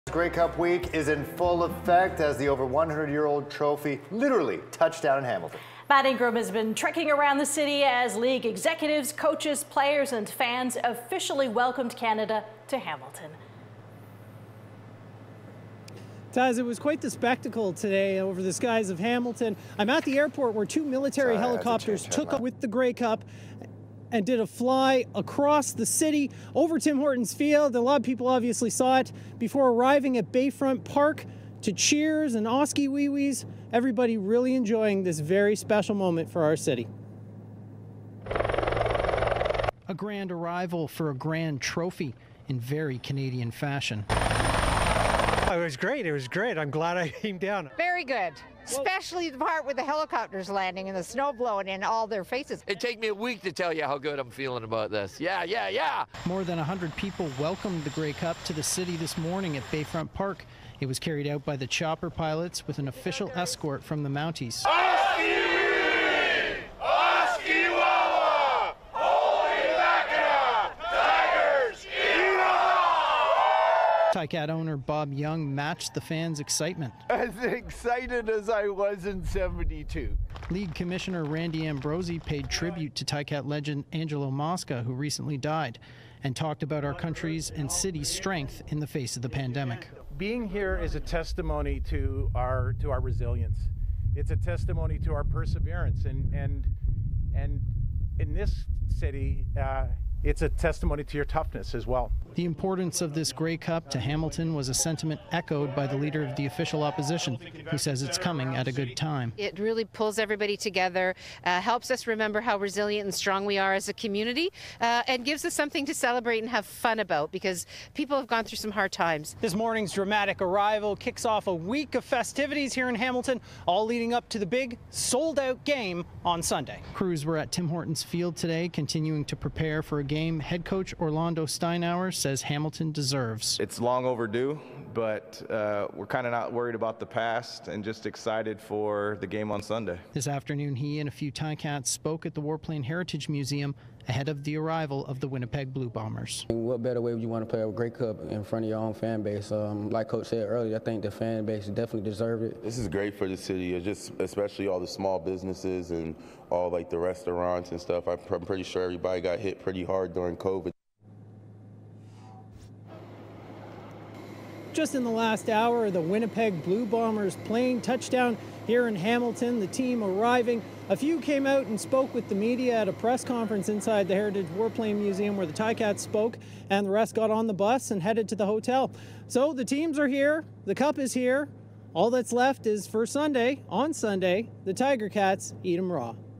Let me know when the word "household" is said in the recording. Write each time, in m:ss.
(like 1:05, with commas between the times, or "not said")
not said.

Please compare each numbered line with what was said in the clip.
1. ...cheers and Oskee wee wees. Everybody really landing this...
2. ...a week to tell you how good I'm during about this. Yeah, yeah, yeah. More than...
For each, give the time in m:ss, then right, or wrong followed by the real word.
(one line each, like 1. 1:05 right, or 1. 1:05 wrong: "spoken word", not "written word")
1. 0:31 wrong: "enjoying", not "landing"
2. 0:53 wrong: "feeling", not "during".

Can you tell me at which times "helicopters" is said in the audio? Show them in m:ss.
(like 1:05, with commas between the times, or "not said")
0:21, 0:49.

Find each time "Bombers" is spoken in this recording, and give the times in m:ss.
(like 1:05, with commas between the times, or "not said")
2:25, 2:46.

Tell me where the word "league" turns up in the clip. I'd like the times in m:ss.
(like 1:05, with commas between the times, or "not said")
0:08, 1:20.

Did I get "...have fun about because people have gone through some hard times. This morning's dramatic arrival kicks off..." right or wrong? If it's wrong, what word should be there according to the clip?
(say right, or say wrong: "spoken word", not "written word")
right.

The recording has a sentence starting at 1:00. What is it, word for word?
It was carried out by the chopper pilots with an official escort from the Mounties.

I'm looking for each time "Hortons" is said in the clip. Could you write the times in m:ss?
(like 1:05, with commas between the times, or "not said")
0:26, 2:07.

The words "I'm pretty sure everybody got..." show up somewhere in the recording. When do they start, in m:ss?
2:38.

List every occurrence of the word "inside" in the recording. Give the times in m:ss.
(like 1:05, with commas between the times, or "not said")
2:53.